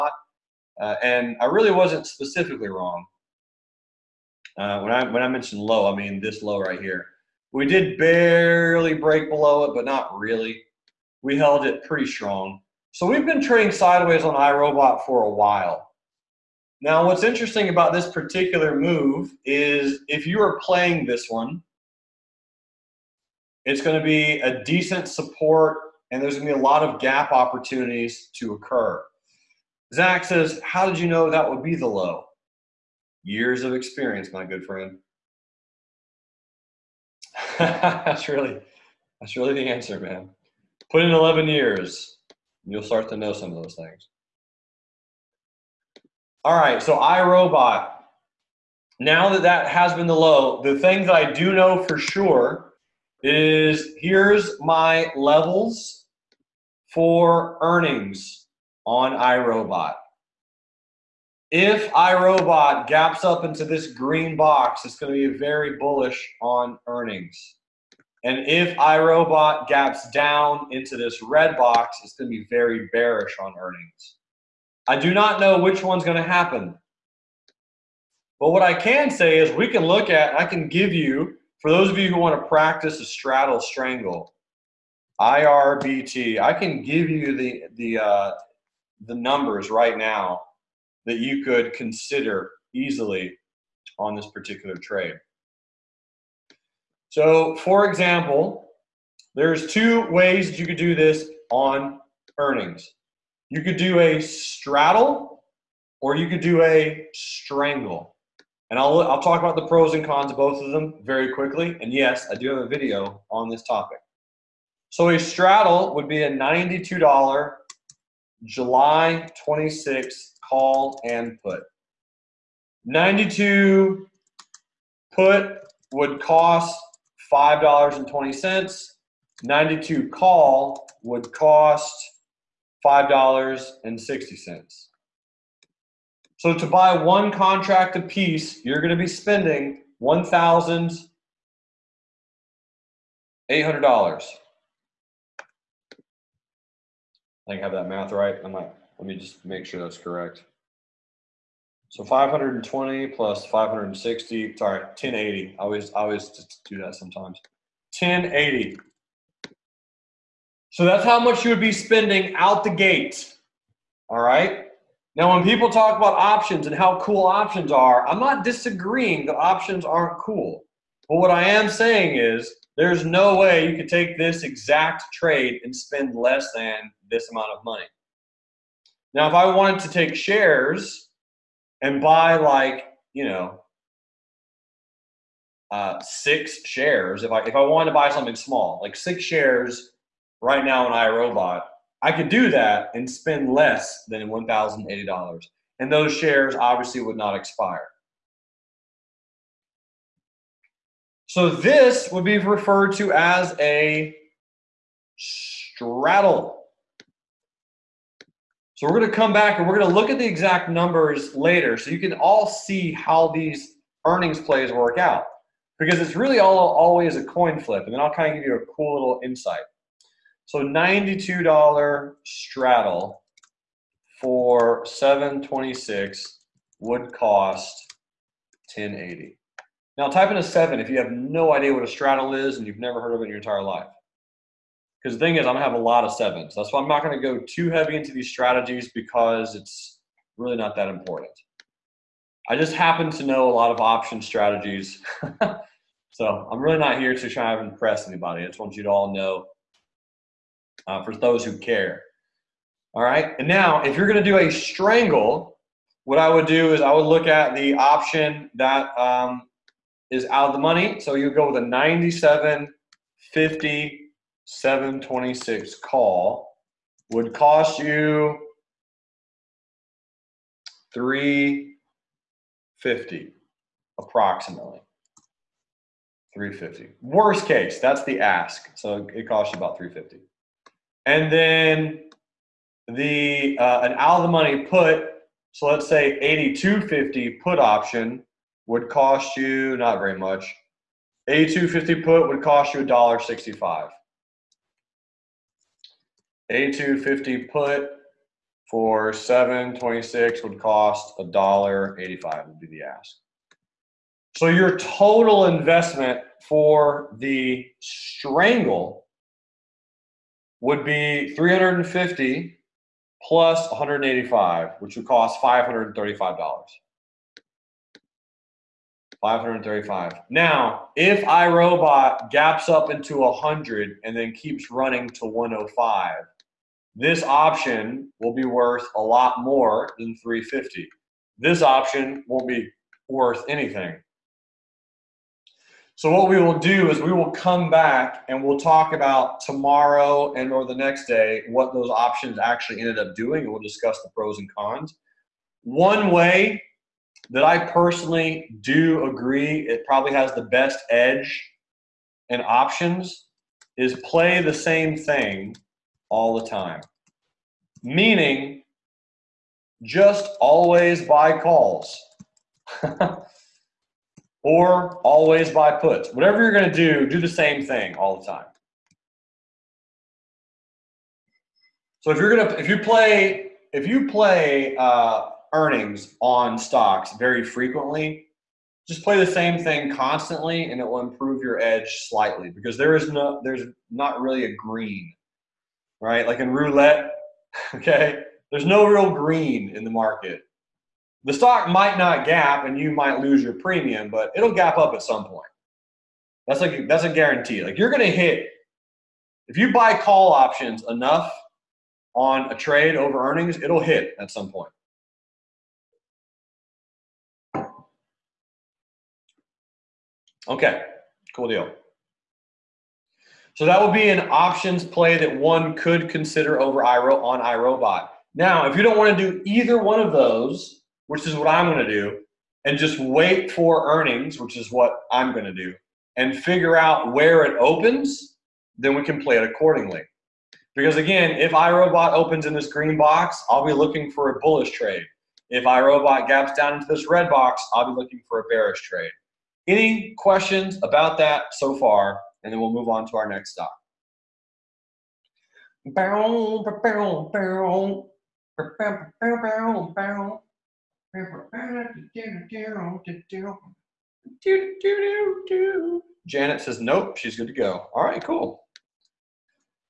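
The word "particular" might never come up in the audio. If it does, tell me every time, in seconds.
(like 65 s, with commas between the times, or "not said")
18 s, 94 s.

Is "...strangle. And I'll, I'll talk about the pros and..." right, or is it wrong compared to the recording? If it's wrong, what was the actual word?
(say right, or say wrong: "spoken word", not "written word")
right.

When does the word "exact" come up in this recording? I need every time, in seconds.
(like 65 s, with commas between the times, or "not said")
174 s, 210 s.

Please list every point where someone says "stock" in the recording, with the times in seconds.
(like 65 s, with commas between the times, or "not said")
376 s, 391 s, 443 s.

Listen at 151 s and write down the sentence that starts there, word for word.
So 520 plus 560, sorry, 1080.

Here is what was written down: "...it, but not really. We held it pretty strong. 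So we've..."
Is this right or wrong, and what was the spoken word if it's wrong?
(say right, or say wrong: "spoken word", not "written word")
right.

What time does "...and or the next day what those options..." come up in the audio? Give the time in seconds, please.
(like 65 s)
340 s.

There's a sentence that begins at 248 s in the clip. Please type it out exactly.
I just want you to all know uh, for those who care.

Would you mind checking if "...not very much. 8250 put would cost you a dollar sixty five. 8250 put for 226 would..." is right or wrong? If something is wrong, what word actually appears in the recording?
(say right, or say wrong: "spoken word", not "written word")
wrong: "726", not "226".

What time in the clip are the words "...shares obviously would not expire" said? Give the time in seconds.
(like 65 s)
196 s.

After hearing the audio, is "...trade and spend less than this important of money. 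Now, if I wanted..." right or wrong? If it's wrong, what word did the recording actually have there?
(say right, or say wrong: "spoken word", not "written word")
wrong: "amount", not "important".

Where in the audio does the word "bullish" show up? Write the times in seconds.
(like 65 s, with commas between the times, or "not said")
65 s, 434 s.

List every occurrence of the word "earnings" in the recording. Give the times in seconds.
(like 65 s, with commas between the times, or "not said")
57 s, 66 s, 73 s, 102 s, 214 s, 375 s, 403 s, 423 s.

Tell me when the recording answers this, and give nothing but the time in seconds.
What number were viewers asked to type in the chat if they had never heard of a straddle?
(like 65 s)
230 s.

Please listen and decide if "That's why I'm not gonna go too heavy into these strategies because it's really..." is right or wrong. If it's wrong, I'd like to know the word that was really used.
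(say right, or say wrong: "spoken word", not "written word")
right.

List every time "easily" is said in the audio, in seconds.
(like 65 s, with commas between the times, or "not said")
92 s.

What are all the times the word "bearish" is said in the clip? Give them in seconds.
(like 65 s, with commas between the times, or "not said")
72 s, 438 s.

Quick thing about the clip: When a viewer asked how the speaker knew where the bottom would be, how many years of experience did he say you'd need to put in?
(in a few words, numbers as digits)
11.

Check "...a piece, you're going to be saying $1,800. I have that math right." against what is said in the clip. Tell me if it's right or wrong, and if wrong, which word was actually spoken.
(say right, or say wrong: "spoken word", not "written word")
wrong: "spending", not "saying".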